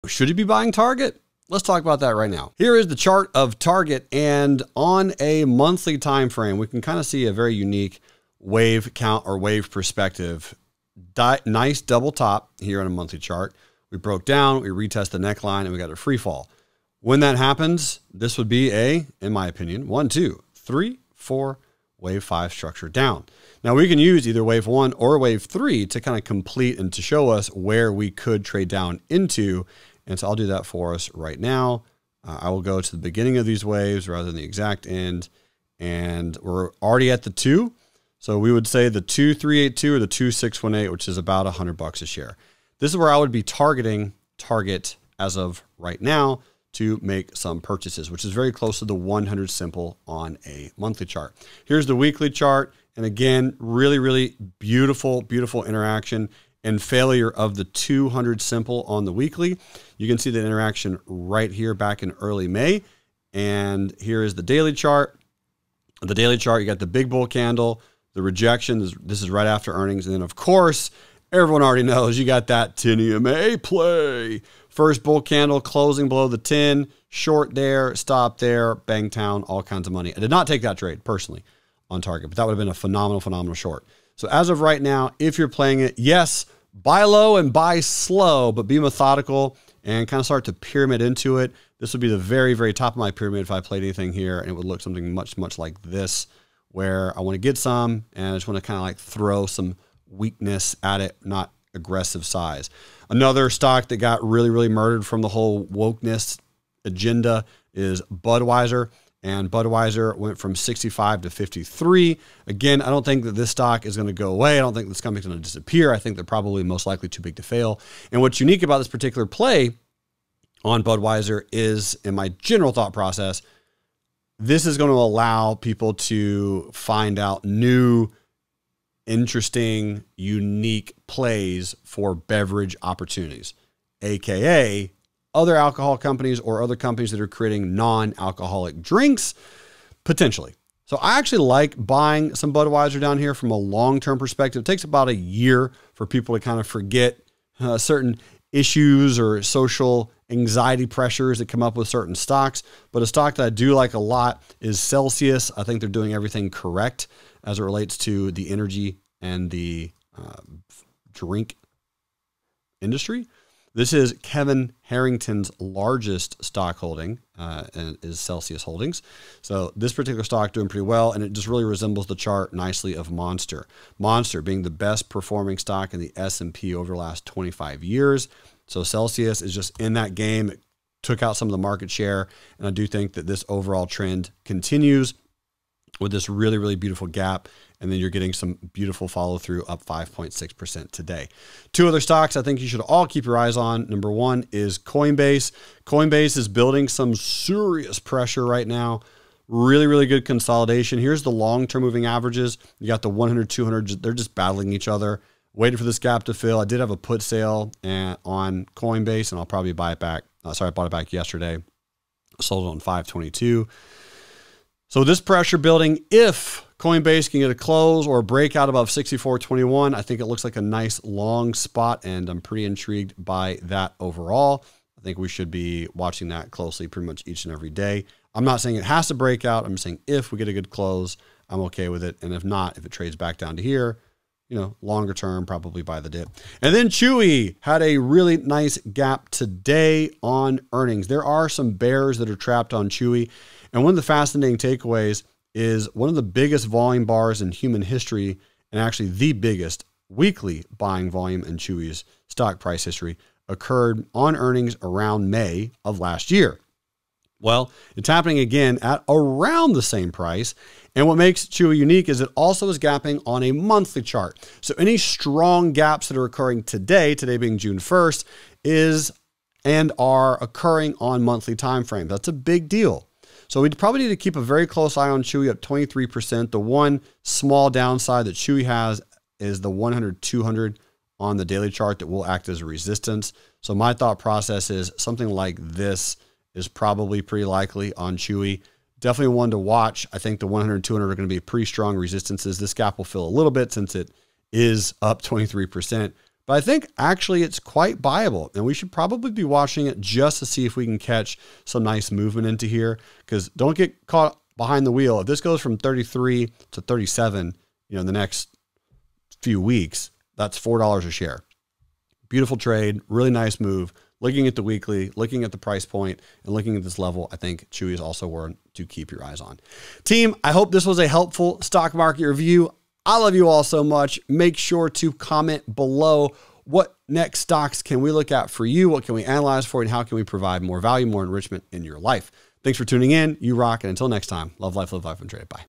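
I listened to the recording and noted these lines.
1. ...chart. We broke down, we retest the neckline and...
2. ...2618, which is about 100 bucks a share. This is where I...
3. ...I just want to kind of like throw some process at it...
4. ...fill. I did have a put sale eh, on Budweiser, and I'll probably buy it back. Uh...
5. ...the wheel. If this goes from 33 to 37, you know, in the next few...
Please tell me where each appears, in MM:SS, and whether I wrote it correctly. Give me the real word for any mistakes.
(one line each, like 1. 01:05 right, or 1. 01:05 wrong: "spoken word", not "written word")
1. 00:13 right
2. 00:40 right
3. 01:38 wrong: "weakness", not "process"
4. 03:26 wrong: "Coinbase", not "Budweiser"
5. 05:04 right.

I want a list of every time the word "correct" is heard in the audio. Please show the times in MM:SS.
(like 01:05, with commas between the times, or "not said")
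02:36.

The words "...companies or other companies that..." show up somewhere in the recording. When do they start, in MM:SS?
02:15.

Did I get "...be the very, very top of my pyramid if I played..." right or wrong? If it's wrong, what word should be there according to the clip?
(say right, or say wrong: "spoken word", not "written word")
right.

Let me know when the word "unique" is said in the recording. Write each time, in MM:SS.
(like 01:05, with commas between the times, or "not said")
00:07, 01:58, 02:10, 04:21.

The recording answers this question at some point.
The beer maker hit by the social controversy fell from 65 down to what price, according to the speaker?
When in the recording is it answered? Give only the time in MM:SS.
01:51.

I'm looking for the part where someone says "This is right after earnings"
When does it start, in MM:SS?
01:09.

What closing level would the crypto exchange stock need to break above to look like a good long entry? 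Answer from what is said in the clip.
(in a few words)
64.21.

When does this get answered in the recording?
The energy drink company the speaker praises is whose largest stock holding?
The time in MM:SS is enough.
02:44.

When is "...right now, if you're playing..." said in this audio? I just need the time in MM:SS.
01:24.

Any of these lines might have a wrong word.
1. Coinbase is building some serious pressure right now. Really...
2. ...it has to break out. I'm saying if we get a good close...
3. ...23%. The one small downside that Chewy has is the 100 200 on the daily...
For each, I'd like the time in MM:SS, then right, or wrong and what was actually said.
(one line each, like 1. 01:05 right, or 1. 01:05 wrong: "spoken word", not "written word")
1. 03:15 right
2. 03:48 right
3. 04:35 right.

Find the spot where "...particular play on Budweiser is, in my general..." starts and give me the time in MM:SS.
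01:58.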